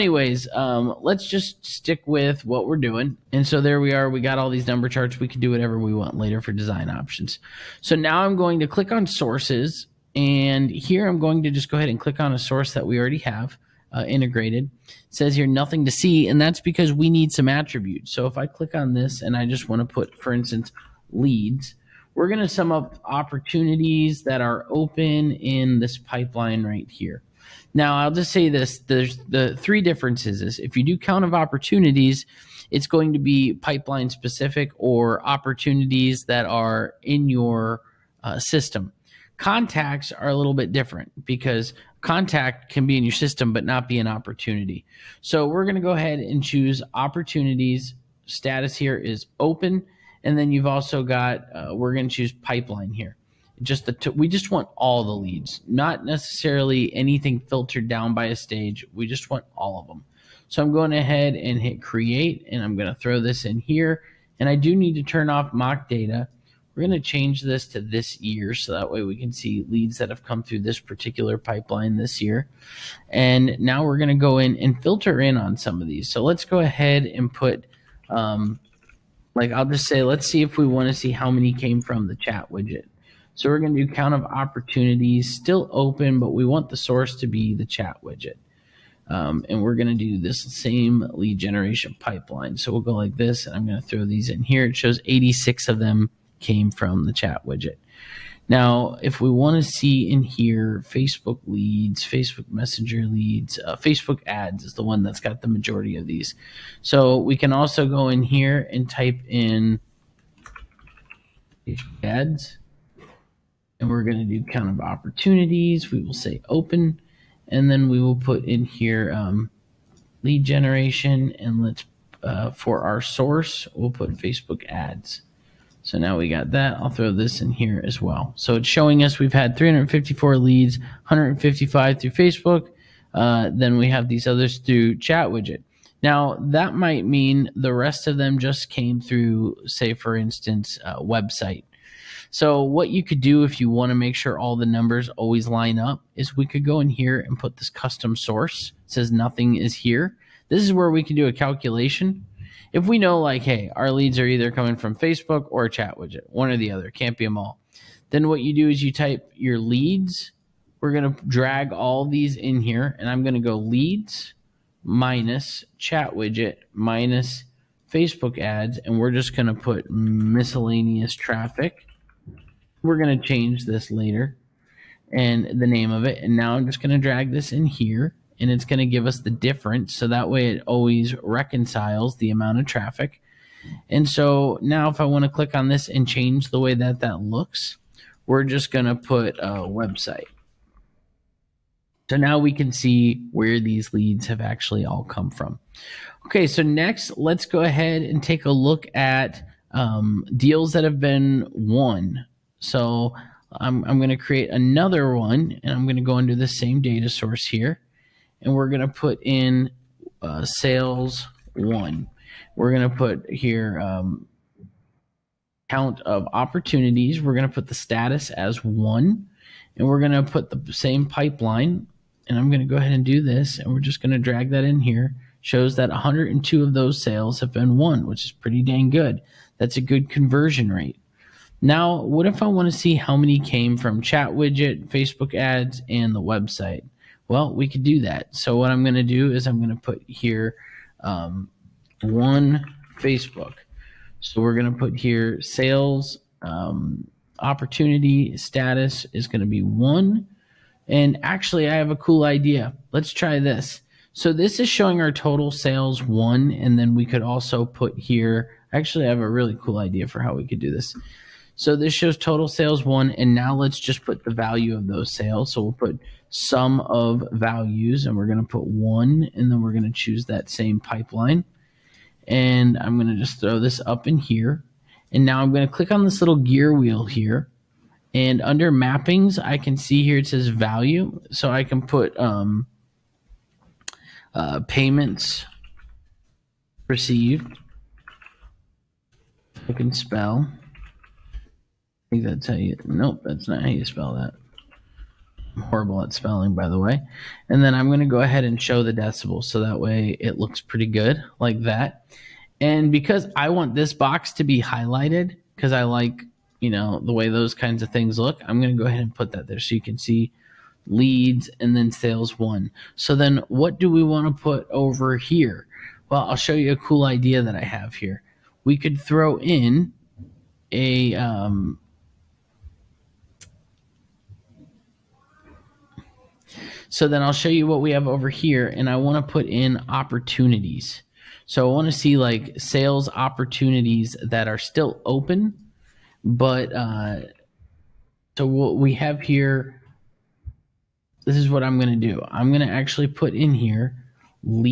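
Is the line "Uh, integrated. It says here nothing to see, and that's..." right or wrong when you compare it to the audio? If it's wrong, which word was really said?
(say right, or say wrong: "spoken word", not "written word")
right.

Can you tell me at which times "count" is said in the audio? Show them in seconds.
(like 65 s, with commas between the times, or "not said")
30 s, 83 s, 114 s, 215 s.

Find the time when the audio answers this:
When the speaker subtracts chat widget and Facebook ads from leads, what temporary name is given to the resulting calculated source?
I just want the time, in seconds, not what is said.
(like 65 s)
169 s.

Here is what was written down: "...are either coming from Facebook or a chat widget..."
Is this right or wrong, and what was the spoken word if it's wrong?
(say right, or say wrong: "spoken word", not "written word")
right.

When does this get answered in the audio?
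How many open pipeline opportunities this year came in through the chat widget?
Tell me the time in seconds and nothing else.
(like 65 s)
95 s.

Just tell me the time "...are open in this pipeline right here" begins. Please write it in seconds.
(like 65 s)
24 s.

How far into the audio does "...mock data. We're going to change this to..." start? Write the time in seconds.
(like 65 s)
65 s.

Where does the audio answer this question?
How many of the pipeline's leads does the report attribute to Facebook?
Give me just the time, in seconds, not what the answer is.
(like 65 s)
130 s.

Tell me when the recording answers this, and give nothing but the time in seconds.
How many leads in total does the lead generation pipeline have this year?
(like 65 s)
129 s.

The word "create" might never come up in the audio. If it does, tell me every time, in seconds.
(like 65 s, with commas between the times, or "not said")
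61 s, 204 s.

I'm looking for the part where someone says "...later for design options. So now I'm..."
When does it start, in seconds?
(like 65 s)
6 s.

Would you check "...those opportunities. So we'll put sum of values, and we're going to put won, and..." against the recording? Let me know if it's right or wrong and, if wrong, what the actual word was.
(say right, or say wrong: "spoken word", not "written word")
wrong: "sales", not "opportunities".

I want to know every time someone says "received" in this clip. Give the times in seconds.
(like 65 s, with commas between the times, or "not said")
286 s.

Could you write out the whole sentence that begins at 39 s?
Contacts are a little bit different because contact can be in your system but not be an opportunity.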